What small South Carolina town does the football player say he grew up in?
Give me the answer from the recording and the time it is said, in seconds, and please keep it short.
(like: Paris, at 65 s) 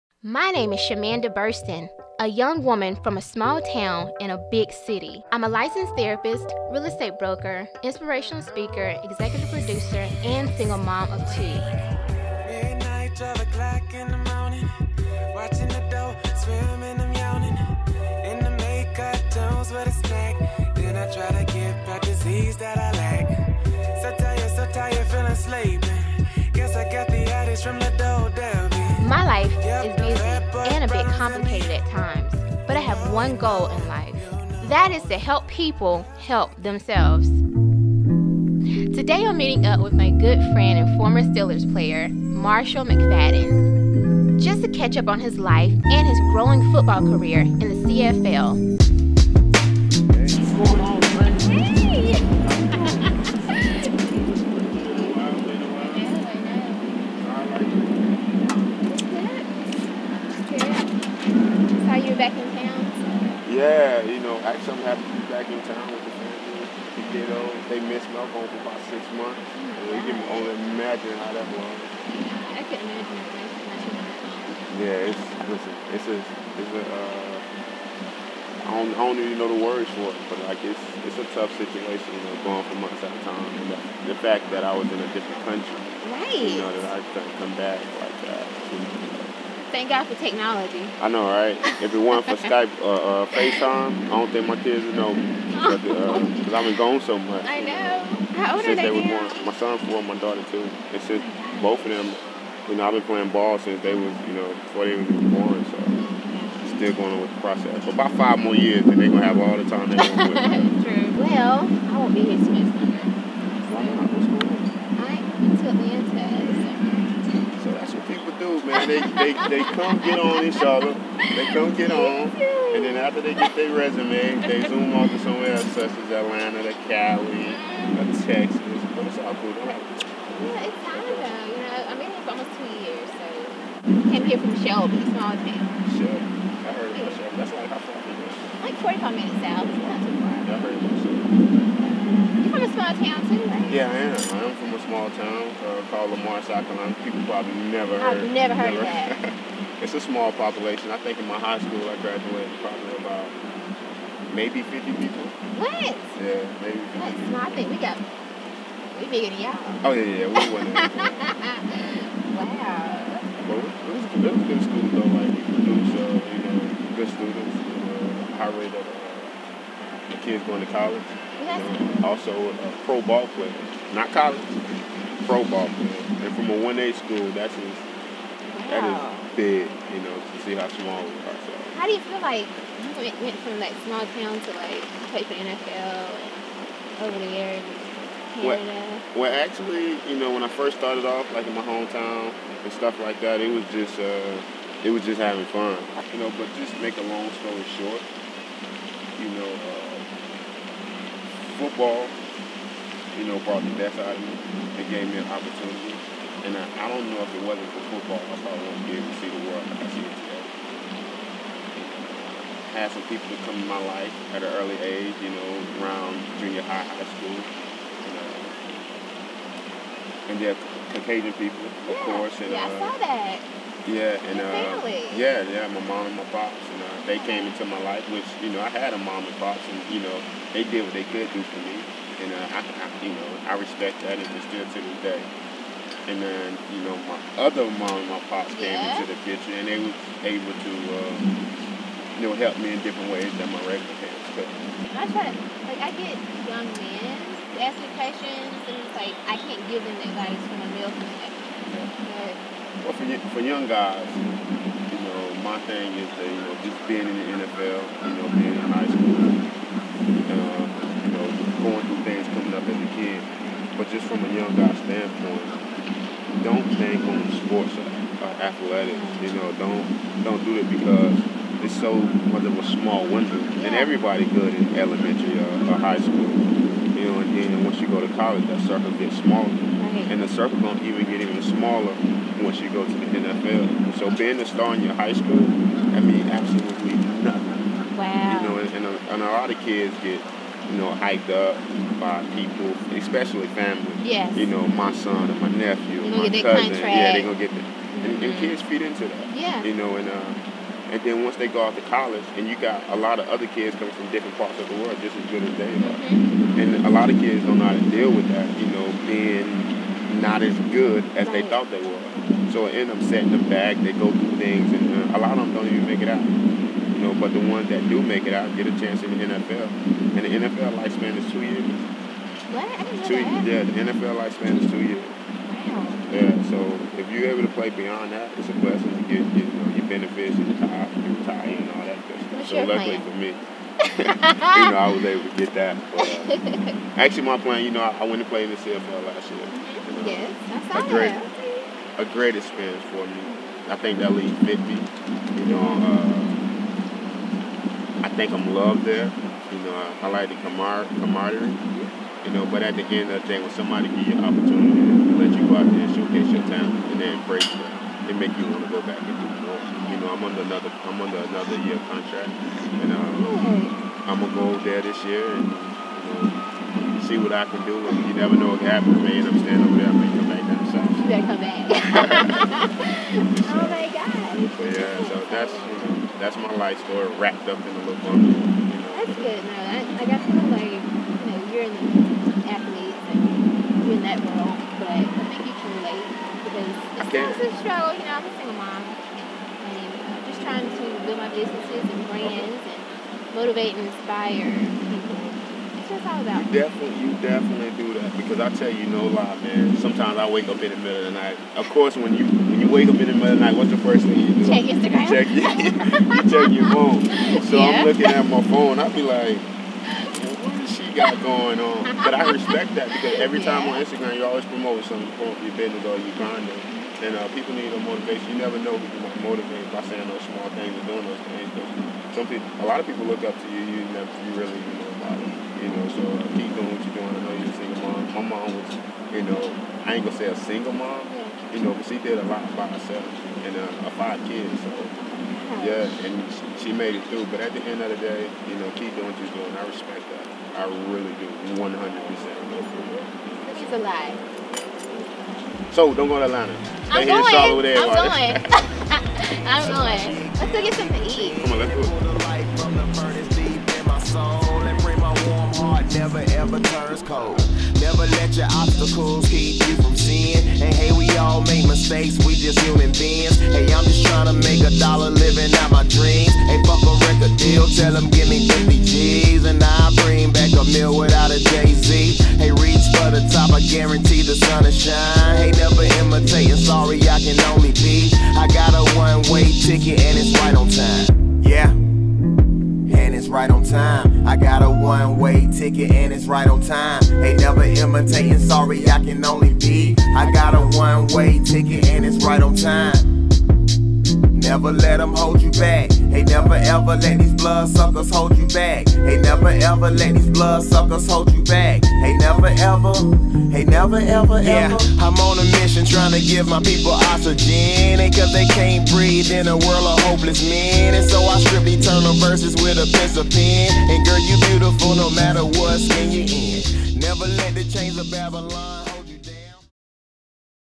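Lamar, at 146 s.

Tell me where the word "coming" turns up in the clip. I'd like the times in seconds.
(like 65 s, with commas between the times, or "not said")
262 s, 303 s.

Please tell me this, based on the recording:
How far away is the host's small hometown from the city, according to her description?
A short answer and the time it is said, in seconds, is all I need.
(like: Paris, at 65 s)
45 minutes, at 138 s.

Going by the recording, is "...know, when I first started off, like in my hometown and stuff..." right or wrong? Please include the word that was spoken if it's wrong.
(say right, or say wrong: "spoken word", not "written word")
right.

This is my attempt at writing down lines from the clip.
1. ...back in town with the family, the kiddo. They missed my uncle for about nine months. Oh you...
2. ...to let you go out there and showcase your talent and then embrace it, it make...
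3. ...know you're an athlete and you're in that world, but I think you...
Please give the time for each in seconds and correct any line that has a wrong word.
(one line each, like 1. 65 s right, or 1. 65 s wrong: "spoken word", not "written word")
1. 65 s wrong: "six", not "nine"
2. 354 s right
3. 380 s right.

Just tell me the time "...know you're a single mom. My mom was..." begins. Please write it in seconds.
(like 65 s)
427 s.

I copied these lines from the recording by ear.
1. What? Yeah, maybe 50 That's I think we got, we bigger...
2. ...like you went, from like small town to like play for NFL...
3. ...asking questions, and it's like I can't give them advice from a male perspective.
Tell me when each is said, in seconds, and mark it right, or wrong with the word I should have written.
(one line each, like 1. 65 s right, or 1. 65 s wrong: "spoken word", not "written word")
1. 155 s right
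2. 182 s right
3. 247 s right.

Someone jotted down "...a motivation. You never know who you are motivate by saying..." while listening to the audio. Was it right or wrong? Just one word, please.
right.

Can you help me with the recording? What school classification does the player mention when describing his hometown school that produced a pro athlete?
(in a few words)
1A.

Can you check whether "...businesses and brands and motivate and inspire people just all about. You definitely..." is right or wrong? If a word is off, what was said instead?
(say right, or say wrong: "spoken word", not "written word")
right.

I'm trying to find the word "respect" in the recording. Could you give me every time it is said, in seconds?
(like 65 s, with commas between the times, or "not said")
233 s, 412 s, 439 s.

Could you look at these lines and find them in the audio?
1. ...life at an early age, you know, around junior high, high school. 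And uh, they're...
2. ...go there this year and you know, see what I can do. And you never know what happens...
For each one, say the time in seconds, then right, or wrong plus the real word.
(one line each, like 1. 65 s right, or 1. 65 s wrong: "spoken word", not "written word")
1. 213 s right
2. 364 s right.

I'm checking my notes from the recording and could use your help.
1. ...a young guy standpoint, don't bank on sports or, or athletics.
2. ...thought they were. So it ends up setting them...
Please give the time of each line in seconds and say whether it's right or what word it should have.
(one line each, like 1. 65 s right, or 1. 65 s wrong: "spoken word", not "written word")
1. 264 s right
2. 311 s right.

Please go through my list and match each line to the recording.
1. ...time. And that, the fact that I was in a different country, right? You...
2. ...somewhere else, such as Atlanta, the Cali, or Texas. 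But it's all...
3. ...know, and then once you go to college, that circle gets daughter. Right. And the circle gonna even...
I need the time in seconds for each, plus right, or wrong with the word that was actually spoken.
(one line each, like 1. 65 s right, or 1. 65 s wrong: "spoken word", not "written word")
1. 83 s right
2. 125 s right
3. 277 s wrong: "smaller", not "daughter".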